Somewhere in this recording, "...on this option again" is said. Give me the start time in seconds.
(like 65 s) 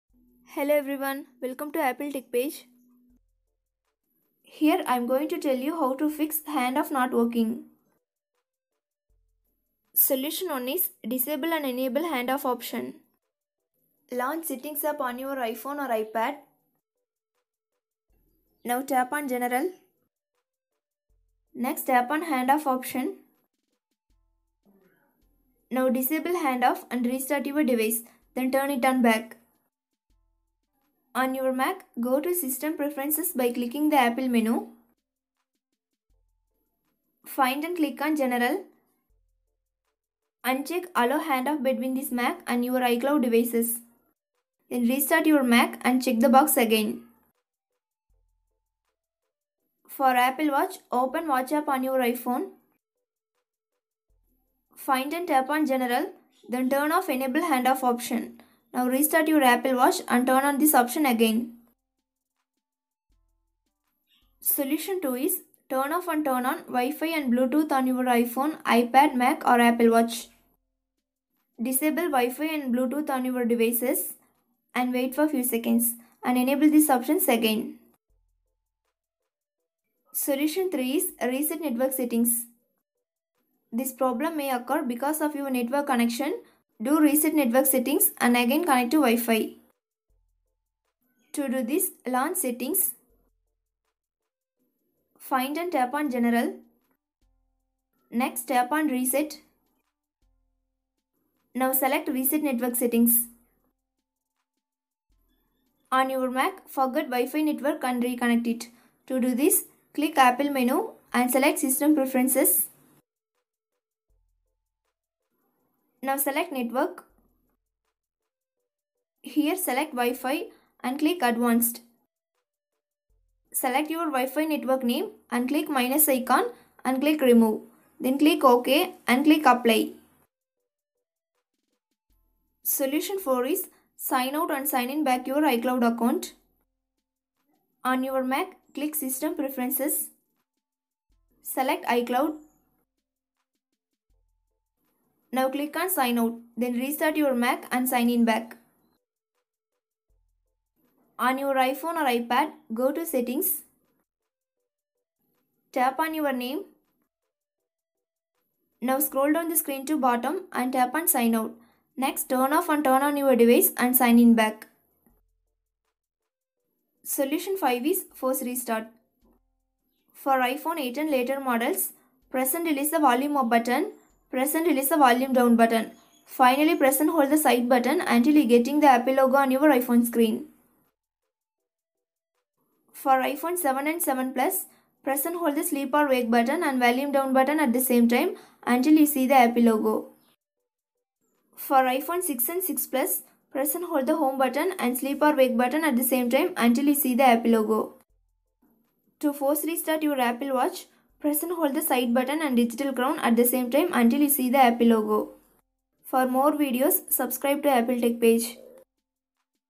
60 s.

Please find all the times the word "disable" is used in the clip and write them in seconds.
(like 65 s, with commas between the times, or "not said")
11 s, 25 s, 71 s.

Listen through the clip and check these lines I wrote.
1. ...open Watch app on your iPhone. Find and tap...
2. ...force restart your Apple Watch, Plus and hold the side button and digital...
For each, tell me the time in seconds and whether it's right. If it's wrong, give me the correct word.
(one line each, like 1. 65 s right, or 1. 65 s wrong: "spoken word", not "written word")
1. 50 s right
2. 199 s wrong: "Press", not "Plus".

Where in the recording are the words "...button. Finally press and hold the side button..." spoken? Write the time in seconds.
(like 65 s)
175 s.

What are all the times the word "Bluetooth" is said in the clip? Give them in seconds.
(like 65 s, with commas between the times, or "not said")
67 s, 72 s.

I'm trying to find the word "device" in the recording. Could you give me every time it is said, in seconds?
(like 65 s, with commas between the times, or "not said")
27 s, 43 s, 73 s, 163 s.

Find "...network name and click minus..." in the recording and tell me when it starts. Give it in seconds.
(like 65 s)
124 s.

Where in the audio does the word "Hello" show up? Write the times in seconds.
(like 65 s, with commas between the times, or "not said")
0 s.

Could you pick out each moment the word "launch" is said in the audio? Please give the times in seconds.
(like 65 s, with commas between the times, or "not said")
14 s, 92 s.